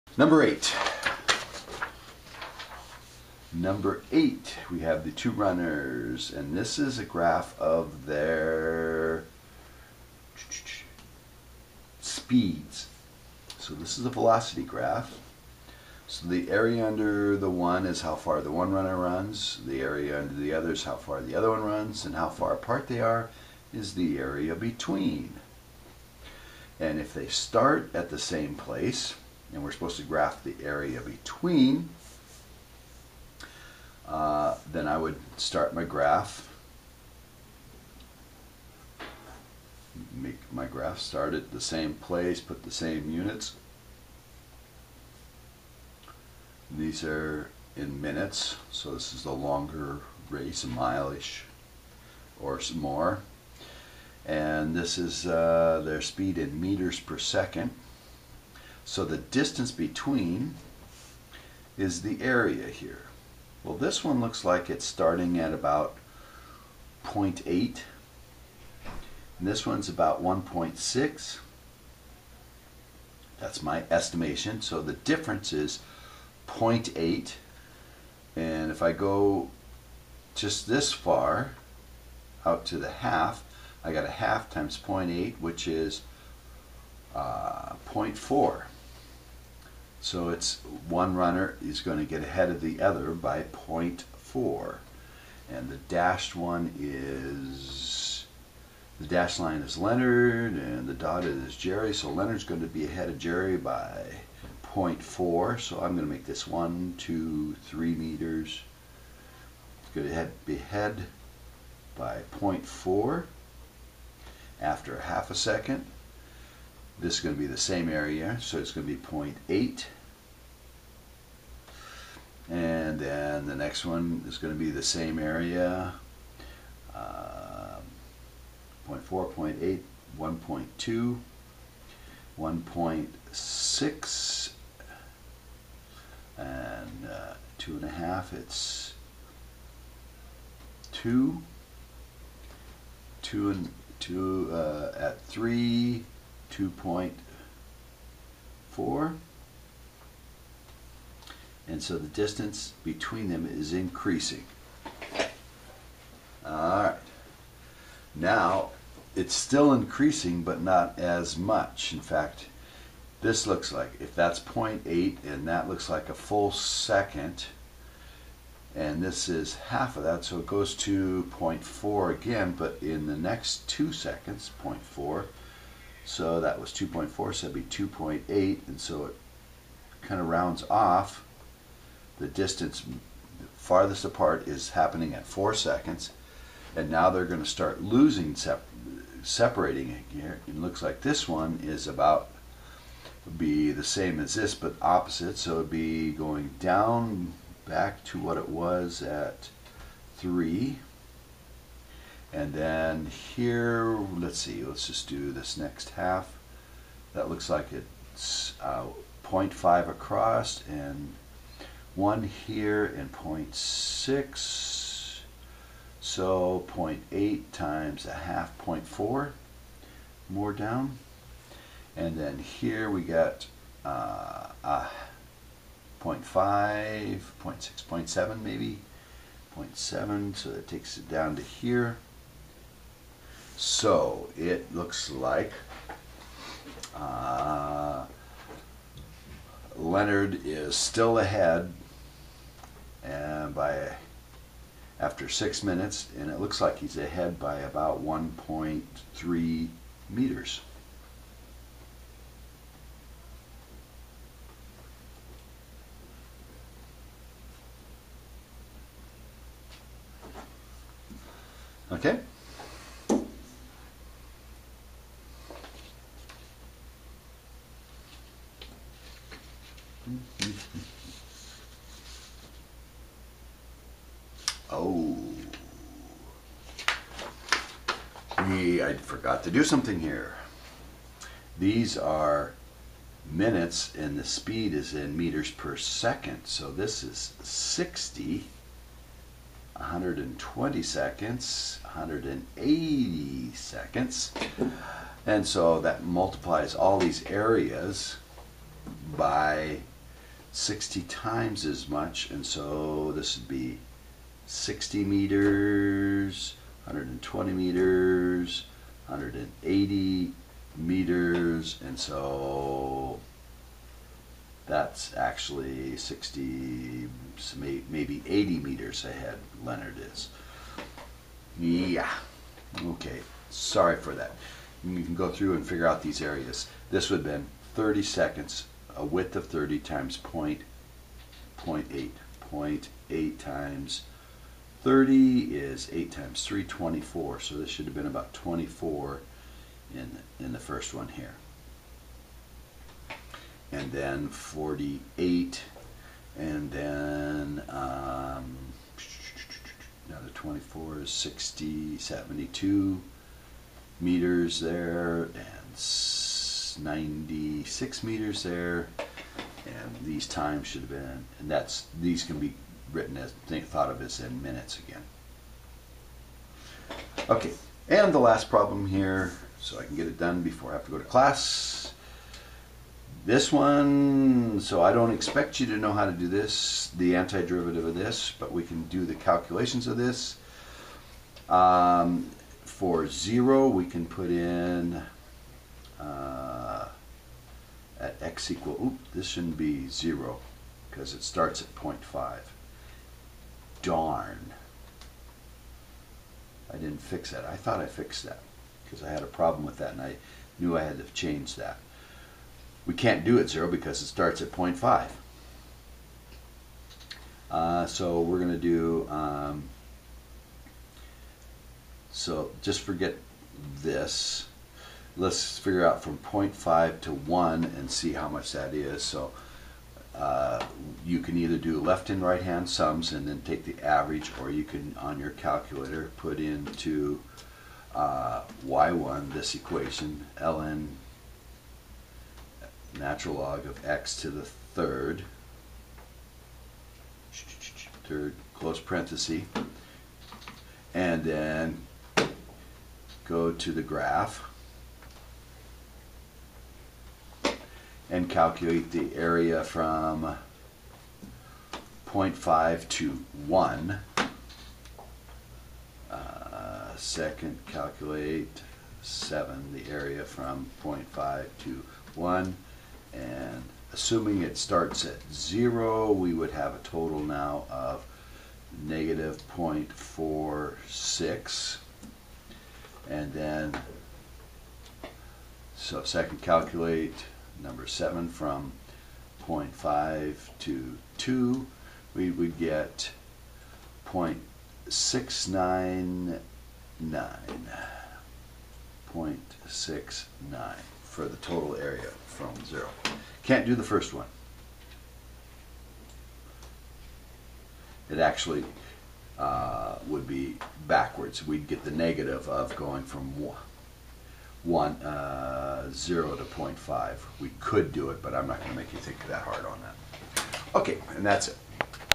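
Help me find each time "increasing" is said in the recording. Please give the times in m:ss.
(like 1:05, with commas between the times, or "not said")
2:33, 2:39.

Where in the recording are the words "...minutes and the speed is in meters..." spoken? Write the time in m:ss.
4:43.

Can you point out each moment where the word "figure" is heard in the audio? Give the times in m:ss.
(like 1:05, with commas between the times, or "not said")
5:25, 6:55.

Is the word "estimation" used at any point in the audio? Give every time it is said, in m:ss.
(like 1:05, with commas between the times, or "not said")
1:13.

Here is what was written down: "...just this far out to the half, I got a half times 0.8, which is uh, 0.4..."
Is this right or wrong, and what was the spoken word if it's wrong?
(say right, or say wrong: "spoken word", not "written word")
right.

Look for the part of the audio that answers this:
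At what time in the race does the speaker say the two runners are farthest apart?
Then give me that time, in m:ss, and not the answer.
3:04.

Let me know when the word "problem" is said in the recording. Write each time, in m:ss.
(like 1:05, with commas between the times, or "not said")
6:08, 6:39.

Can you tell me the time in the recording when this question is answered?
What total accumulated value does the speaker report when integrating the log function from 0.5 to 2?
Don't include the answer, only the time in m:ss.
8:04.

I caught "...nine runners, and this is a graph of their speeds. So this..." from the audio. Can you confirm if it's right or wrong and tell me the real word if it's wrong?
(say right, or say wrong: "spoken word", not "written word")
wrong: "two", not "nine".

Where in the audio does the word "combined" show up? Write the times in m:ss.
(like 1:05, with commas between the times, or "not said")
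not said.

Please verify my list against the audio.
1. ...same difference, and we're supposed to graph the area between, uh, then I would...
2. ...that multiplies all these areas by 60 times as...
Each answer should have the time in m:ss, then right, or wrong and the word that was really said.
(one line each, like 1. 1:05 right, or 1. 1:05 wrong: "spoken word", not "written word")
1. 0:28 wrong: "place", not "difference"
2. 4:55 right.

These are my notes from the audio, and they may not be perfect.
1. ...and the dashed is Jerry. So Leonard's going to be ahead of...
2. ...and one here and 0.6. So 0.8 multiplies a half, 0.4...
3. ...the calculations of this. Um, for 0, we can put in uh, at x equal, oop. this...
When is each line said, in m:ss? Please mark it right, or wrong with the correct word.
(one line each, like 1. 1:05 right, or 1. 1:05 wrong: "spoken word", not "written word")
1. 1:40 wrong: "dotted", not "dashed"
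2. 3:30 wrong: "times", not "multiplies"
3. 6:19 right.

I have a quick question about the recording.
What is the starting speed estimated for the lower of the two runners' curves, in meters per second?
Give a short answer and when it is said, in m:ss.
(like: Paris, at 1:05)
0.8, at 1:04.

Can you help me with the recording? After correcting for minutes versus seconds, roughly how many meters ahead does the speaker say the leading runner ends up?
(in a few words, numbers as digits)
80 meters.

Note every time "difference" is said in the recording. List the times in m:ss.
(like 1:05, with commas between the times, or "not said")
1:14.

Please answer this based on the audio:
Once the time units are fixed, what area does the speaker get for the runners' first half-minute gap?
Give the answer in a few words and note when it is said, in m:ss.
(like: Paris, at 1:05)
24, at 5:35.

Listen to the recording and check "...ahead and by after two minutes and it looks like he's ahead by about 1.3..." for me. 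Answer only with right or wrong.
wrong.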